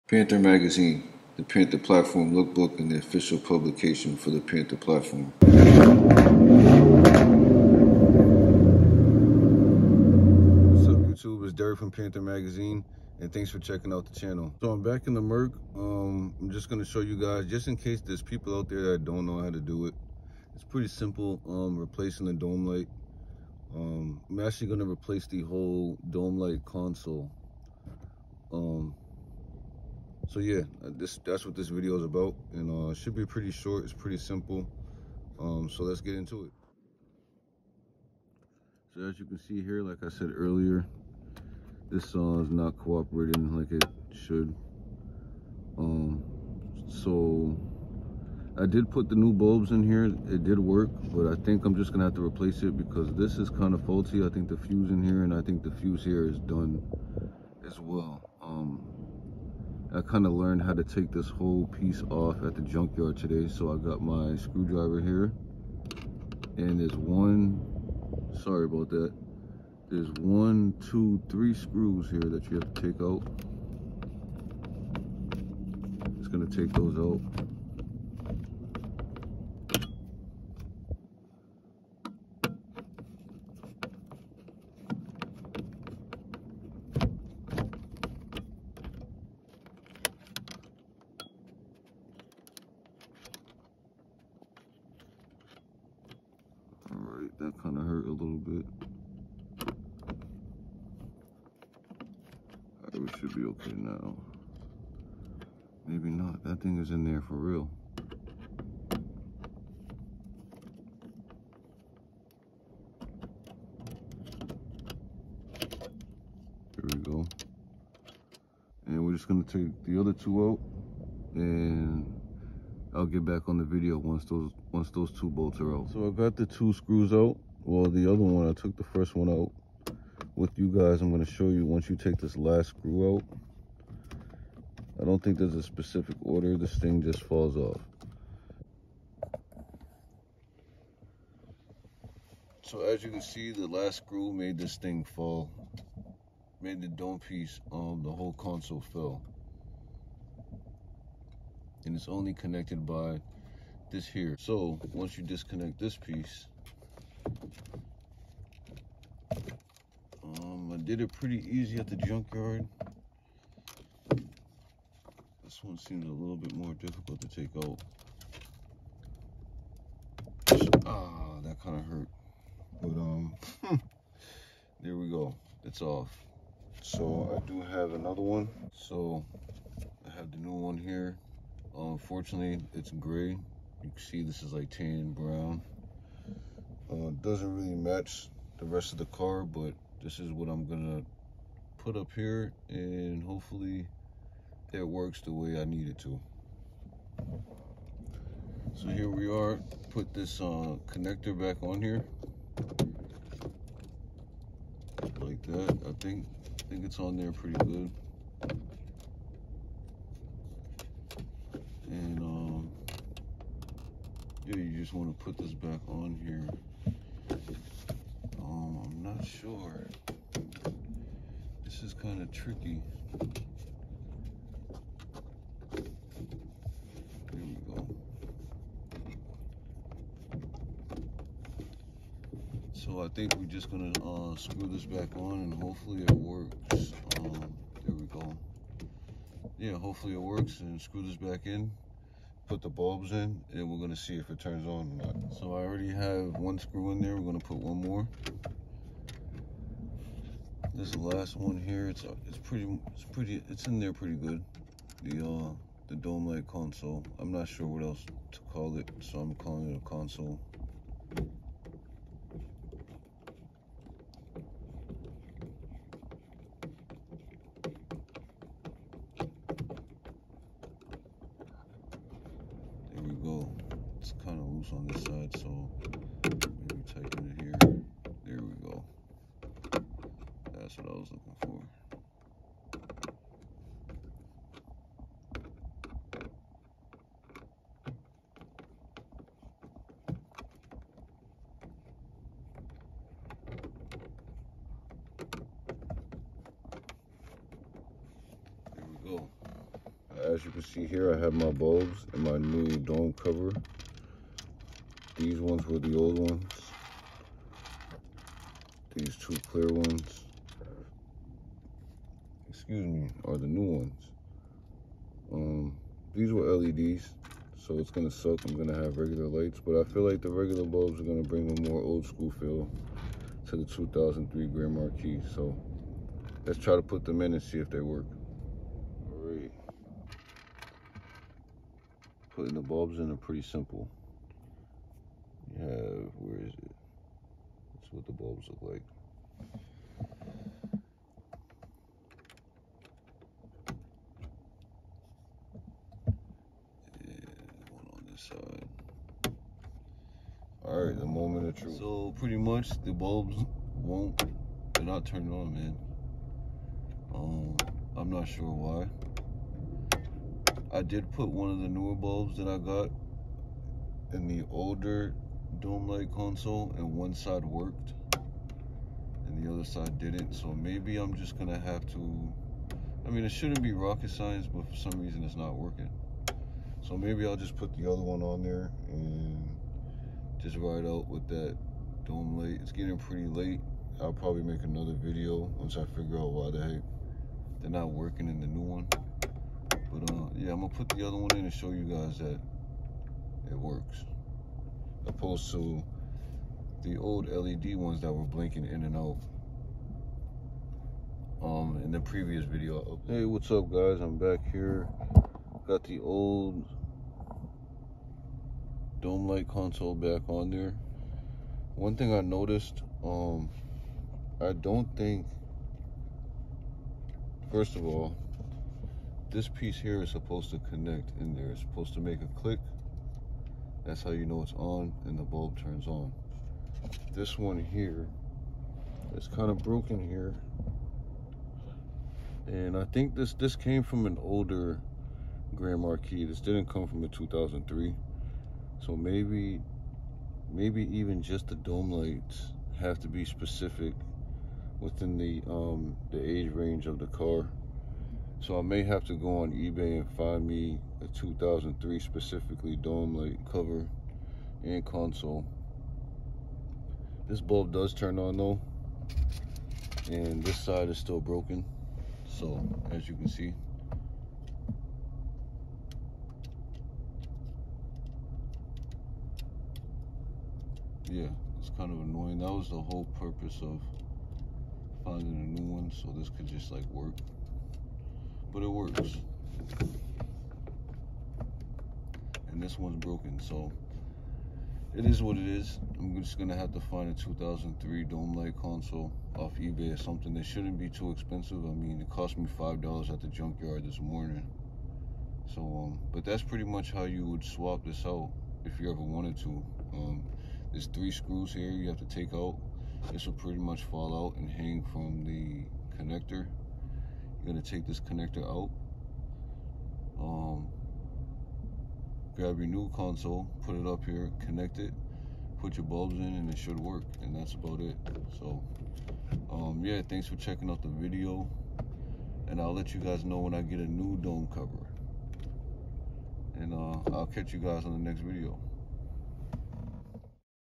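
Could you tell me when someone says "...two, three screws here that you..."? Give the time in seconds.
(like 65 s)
70 s.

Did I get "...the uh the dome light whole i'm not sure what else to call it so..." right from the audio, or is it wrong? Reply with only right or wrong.
wrong.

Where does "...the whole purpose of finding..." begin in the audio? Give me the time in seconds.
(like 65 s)
472 s.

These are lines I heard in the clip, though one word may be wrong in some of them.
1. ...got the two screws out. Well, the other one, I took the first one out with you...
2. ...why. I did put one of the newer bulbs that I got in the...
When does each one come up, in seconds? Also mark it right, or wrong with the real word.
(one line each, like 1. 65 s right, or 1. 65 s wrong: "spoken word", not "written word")
1. 126 s right
2. 358 s right.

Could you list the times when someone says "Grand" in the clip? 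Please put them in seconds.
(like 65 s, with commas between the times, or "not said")
324 s, 435 s.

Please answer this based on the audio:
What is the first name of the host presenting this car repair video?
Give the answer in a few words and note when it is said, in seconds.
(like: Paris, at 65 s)
Derek, at 11 s.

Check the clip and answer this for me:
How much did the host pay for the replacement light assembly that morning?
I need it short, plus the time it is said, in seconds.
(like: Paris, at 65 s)
$5, at 492 s.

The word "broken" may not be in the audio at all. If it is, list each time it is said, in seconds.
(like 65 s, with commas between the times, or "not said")
429 s, 461 s, 483 s.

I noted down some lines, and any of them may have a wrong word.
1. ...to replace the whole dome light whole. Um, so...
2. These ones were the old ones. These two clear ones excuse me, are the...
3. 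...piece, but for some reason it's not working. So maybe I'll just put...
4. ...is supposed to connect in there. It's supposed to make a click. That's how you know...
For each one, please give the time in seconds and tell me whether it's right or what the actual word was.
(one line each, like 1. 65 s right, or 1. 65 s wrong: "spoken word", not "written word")
1. 24 s wrong: "console", not "whole"
2. 305 s right
3. 374 s wrong: "science", not "piece"
4. 420 s right.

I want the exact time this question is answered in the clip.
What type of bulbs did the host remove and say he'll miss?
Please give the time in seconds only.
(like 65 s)
316 s.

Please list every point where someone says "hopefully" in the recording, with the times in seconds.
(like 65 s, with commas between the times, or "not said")
193 s, 235 s, 239 s.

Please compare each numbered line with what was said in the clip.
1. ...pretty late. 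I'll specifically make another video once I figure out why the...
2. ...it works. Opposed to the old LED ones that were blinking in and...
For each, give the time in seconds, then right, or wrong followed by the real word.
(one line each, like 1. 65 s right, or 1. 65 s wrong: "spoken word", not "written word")
1. 382 s wrong: "probably", not "specifically"
2. 393 s right.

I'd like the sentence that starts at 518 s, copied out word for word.
So um, yeah, thanks for checking out the video.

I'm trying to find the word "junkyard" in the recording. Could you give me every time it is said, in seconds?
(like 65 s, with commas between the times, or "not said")
62 s, 161 s, 493 s.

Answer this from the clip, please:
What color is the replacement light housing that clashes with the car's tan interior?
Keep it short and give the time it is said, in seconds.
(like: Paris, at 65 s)
Gray, at 182 s.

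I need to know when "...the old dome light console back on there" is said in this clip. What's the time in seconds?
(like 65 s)
405 s.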